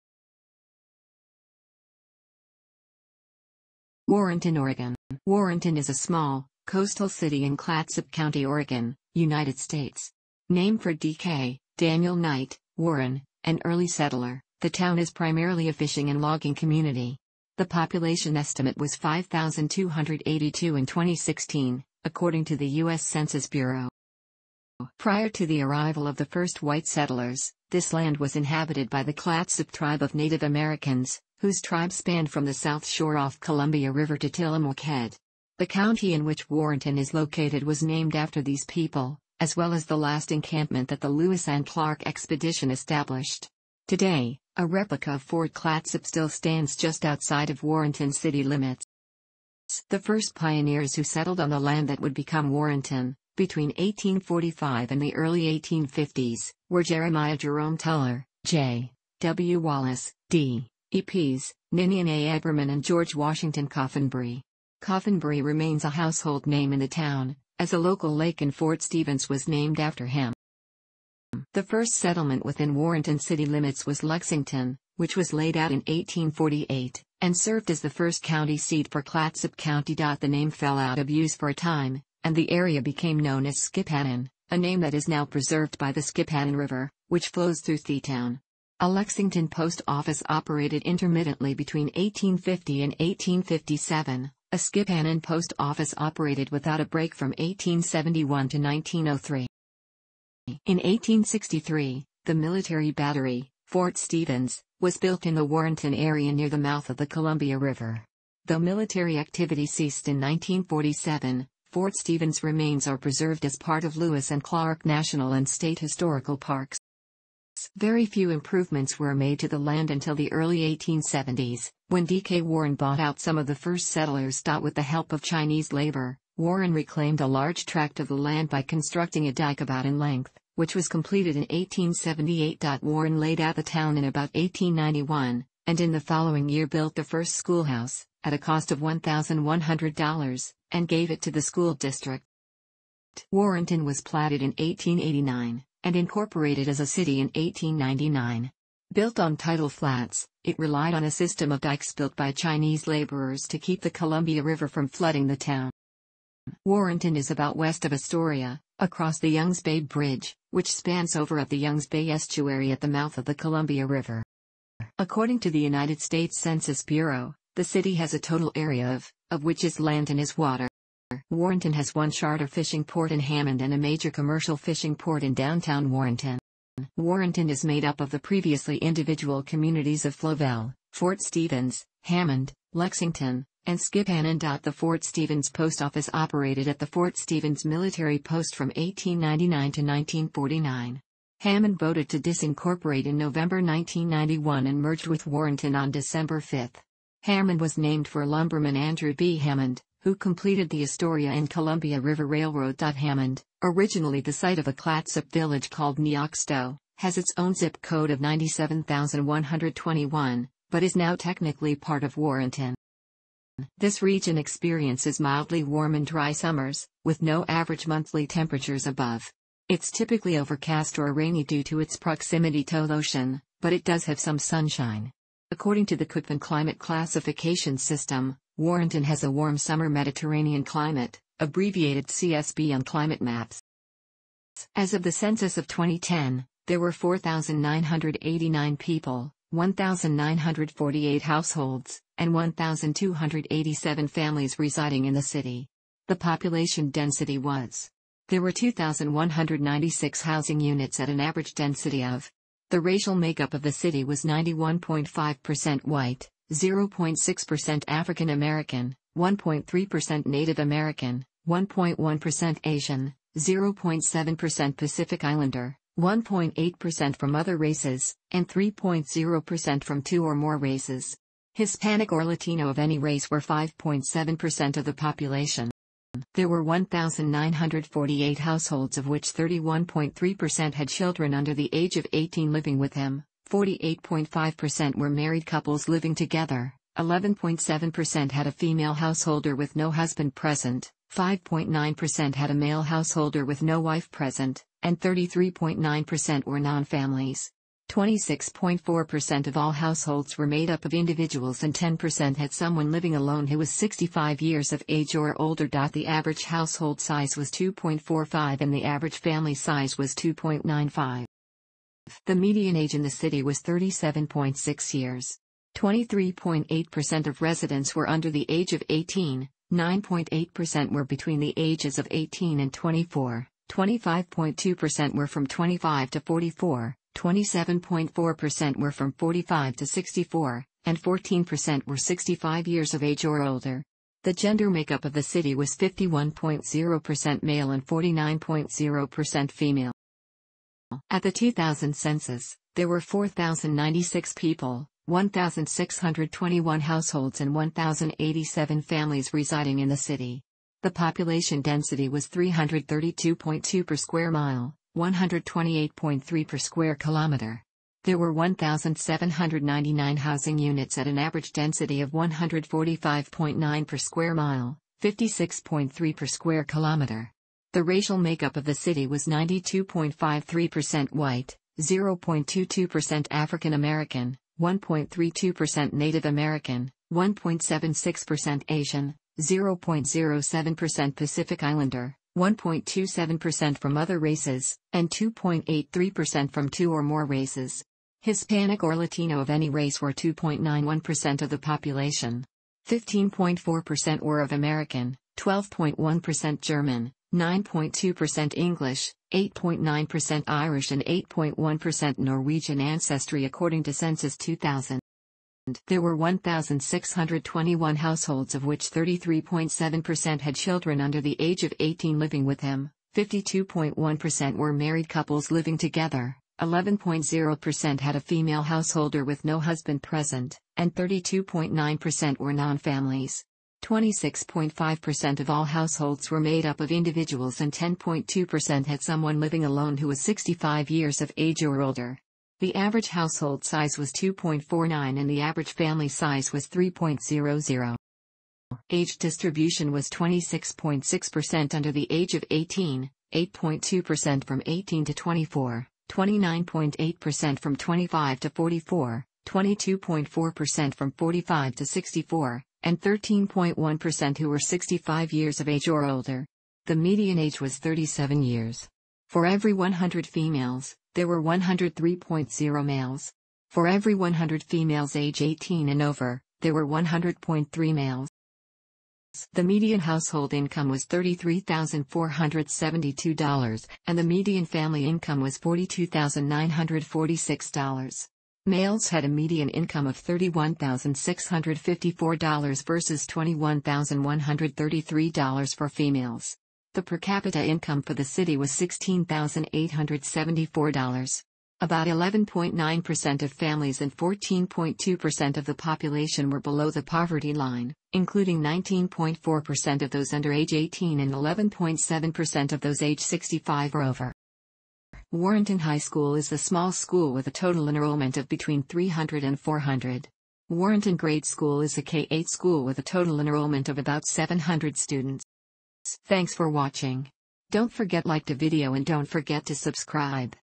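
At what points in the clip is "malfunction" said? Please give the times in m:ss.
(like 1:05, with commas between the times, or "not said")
not said.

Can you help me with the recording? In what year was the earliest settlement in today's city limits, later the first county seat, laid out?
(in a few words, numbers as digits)
1848.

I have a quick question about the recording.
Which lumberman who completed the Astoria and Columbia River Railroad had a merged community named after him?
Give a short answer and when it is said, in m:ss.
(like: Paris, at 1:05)
Andrew B. Hammond, at 3:18.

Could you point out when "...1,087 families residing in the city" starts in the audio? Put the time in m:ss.
5:47.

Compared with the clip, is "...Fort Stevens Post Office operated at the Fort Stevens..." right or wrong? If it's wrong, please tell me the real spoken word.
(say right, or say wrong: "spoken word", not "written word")
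right.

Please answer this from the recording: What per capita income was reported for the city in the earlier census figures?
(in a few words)
$16,874.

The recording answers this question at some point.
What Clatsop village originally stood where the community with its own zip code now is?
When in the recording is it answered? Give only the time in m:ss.
3:25.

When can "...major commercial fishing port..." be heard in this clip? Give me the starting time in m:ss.
2:53.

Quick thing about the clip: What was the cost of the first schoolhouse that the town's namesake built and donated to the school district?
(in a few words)
$1,100.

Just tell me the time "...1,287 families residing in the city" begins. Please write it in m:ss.
4:02.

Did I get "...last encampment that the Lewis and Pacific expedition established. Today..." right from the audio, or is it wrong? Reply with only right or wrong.
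wrong.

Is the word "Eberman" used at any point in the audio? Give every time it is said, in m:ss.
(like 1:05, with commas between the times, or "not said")
1:02.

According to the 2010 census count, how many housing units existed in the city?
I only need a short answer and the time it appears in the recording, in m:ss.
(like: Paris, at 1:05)
2,196, at 4:08.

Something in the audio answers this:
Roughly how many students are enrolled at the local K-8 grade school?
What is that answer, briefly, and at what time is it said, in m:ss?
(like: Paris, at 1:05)
700, at 8:34.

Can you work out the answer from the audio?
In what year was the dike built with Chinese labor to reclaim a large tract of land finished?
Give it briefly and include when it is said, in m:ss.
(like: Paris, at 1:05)
1878, at 2:11.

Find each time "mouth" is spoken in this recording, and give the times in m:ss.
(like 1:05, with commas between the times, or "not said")
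1:46, 2:42.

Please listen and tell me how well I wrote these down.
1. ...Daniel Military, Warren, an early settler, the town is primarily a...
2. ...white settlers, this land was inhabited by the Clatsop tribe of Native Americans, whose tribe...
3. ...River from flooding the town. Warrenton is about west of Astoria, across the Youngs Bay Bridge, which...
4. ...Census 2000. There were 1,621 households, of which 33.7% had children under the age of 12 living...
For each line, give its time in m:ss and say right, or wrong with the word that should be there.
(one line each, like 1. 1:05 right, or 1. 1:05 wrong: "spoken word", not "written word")
1. 0:11 wrong: "Knight", not "Military"
2. 0:26 right
3. 2:34 right
4. 6:43 wrong: "18", not "12".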